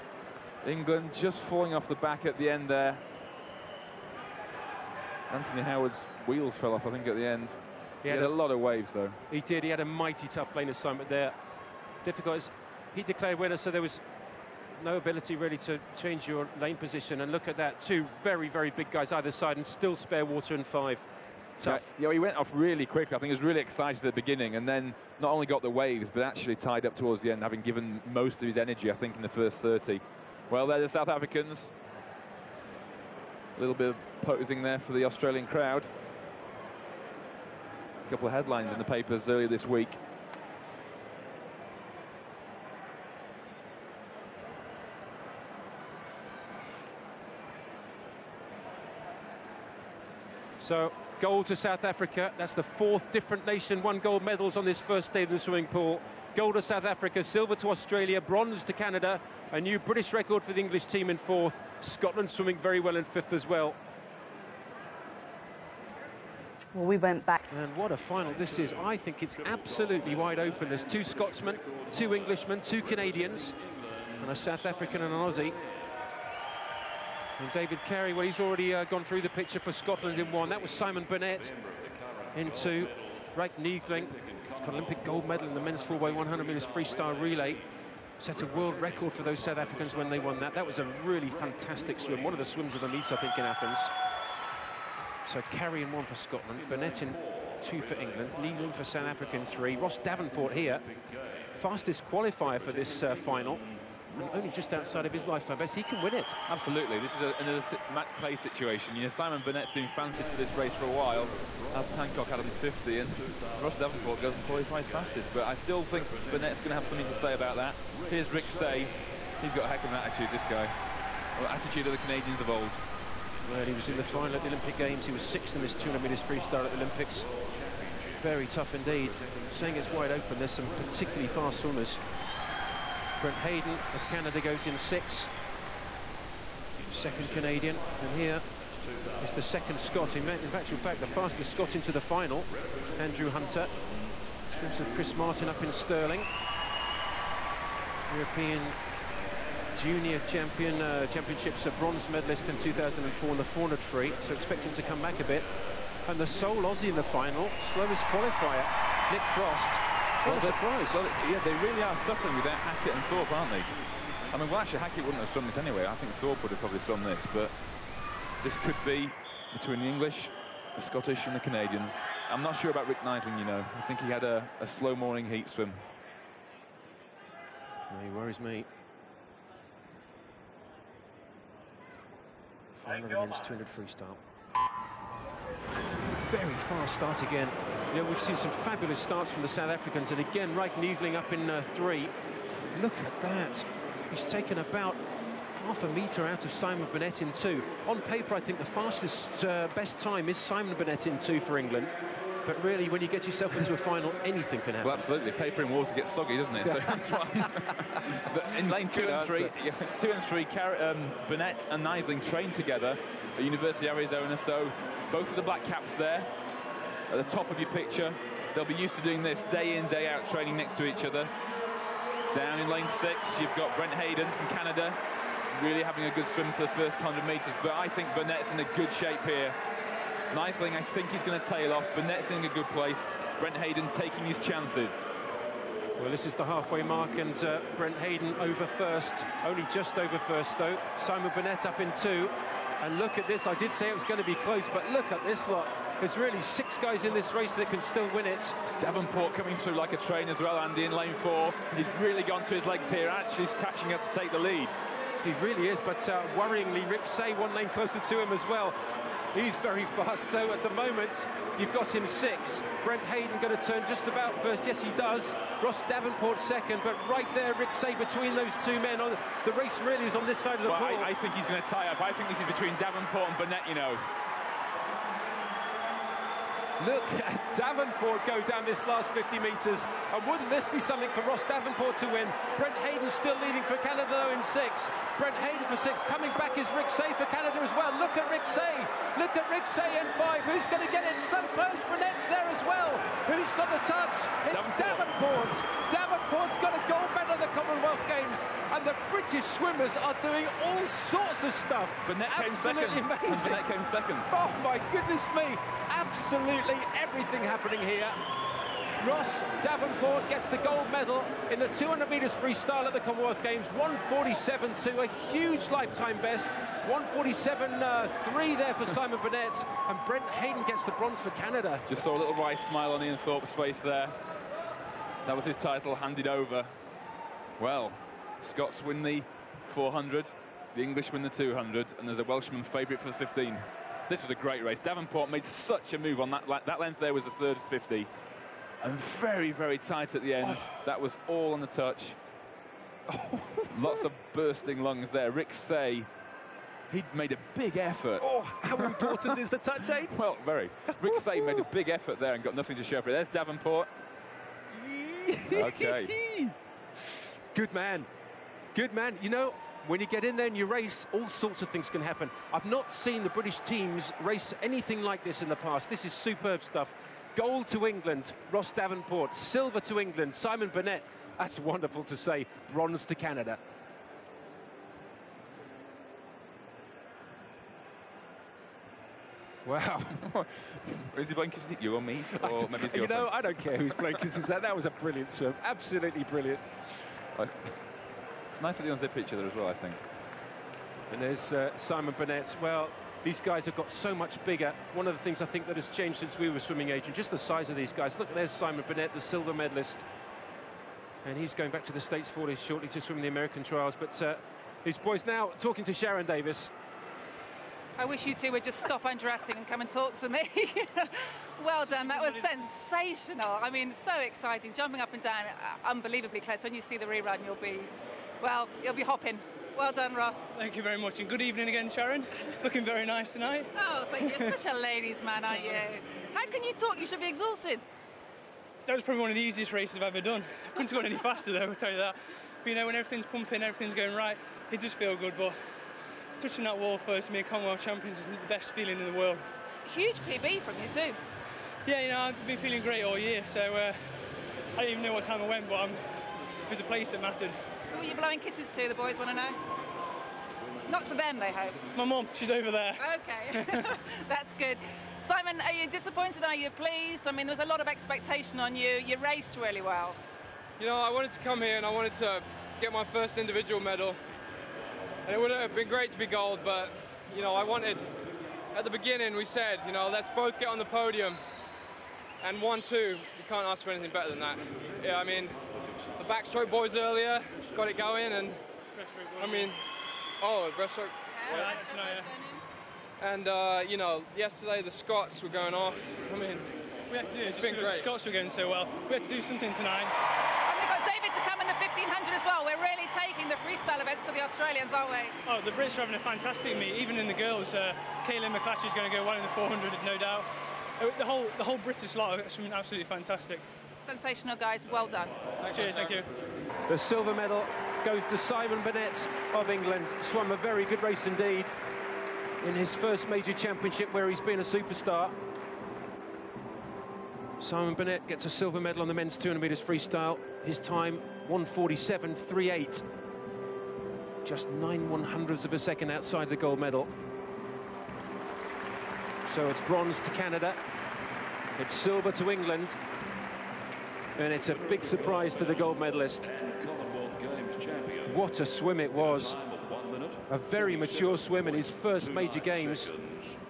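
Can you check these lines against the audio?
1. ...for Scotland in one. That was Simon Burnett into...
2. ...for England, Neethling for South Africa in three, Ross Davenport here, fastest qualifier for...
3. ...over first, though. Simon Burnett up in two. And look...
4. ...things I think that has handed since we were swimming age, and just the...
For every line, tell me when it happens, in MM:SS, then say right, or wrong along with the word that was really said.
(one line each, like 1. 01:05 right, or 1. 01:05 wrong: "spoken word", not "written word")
1. 01:19 right
2. 01:37 right
3. 03:59 right
4. 06:35 wrong: "changed", not "handed".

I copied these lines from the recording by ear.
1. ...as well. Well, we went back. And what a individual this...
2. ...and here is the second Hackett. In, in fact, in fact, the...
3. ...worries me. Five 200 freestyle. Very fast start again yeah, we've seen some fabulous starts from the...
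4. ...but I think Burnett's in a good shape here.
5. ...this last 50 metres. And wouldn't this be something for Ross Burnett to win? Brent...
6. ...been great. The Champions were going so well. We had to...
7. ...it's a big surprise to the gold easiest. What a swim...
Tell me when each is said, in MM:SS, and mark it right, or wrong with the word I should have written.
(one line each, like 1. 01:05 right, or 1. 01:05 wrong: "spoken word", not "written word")
1. 01:03 wrong: "final", not "individual"
2. 02:18 wrong: "Scot", not "Hackett"
3. 02:58 right
4. 03:47 right
5. 04:38 wrong: "Davenport", not "Burnett"
6. 08:07 wrong: "Scots", not "Champions"
7. 08:54 wrong: "medalist", not "easiest".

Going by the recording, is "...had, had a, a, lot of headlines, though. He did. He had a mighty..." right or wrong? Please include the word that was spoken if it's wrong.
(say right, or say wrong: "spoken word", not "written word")
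wrong: "waves", not "headlines".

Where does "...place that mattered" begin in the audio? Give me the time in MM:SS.
07:26.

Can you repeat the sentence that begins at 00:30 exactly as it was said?
Well, there are the South Africans.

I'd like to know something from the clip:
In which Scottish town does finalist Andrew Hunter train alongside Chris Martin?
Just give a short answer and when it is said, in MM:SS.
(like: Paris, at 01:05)
Stirling, at 02:25.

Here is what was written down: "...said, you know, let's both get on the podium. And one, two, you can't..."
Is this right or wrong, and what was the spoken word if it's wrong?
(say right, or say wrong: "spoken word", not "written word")
right.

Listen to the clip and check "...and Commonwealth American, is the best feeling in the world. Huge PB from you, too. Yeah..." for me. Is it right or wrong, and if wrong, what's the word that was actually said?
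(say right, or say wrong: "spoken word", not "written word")
wrong: "Champions", not "American".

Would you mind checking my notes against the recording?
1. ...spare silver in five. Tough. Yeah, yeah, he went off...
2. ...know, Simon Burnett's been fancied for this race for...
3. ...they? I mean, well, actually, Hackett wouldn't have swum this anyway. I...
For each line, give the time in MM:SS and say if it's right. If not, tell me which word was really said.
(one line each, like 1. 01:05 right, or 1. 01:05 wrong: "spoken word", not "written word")
1. 00:19 wrong: "water", not "silver"
2. 01:49 right
3. 02:43 right.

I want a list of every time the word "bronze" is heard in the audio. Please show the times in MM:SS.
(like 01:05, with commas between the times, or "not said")
00:58, 02:31, 05:20, 06:12, 08:49.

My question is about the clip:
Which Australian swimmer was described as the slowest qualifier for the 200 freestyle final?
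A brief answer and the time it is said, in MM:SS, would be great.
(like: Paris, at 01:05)
Nick Frost, at 02:39.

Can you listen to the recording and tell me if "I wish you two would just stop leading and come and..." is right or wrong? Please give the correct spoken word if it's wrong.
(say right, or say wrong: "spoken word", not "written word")
wrong: "undressing", not "leading".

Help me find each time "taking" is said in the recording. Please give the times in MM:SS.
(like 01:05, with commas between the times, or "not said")
03:53, 08:13.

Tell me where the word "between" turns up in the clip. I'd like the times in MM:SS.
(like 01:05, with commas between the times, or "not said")
02:49, 04:27, 04:32.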